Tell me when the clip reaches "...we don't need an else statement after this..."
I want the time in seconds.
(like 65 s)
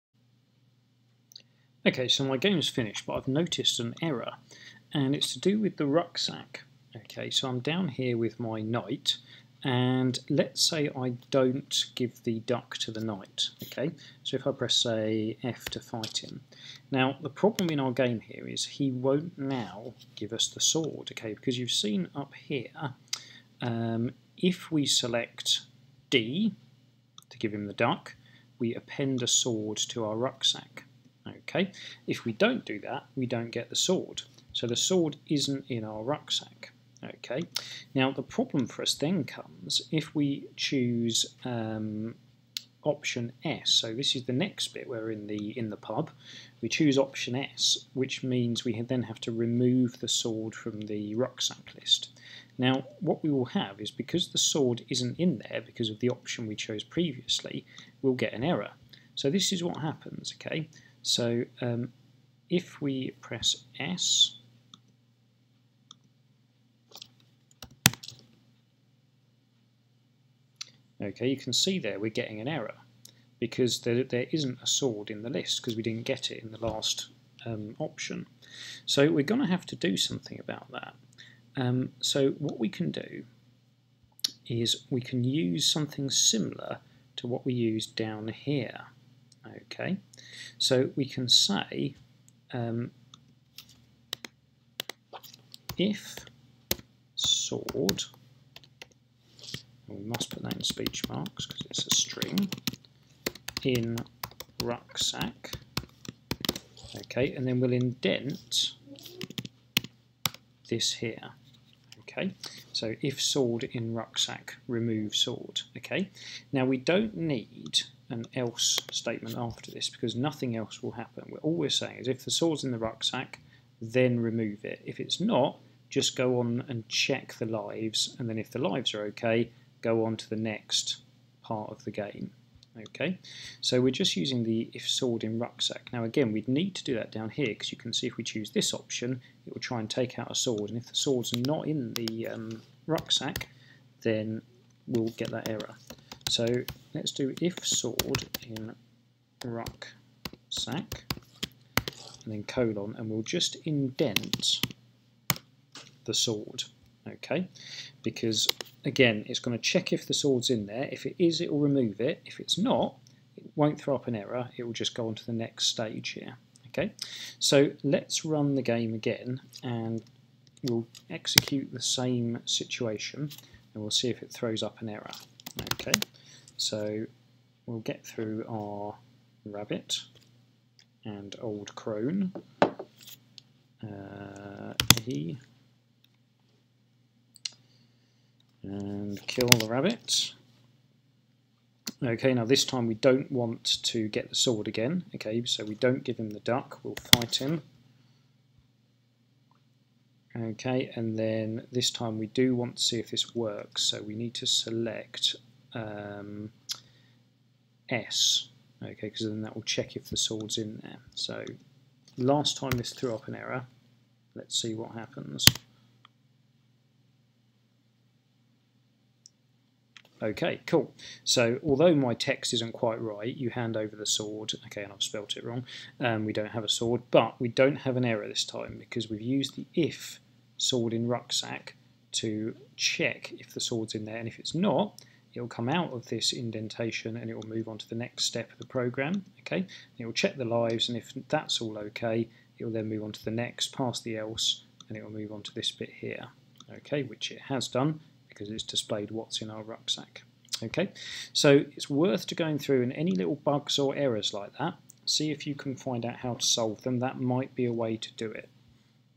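116 s.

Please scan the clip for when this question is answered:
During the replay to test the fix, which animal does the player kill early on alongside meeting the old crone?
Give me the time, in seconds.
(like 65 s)
189 s.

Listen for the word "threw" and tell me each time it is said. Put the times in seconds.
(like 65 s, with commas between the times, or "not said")
212 s.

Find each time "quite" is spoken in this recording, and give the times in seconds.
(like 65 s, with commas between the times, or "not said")
222 s.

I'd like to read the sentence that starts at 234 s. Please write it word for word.
And if it's not, it'll come out of this indentation and it will move on to the next step of the program.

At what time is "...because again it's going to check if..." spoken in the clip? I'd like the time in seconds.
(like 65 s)
158 s.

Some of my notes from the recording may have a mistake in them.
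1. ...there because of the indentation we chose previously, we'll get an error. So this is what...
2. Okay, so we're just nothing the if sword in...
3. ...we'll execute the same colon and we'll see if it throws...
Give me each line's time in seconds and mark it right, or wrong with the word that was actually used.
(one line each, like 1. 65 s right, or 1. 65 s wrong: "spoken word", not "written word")
1. 55 s wrong: "option", not "indentation"
2. 132 s wrong: "using", not "nothing"
3. 170 s wrong: "situation", not "colon".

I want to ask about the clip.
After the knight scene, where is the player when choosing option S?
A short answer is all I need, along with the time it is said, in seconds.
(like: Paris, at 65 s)
The pub, at 45 s.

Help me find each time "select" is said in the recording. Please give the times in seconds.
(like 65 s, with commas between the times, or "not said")
24 s, 204 s.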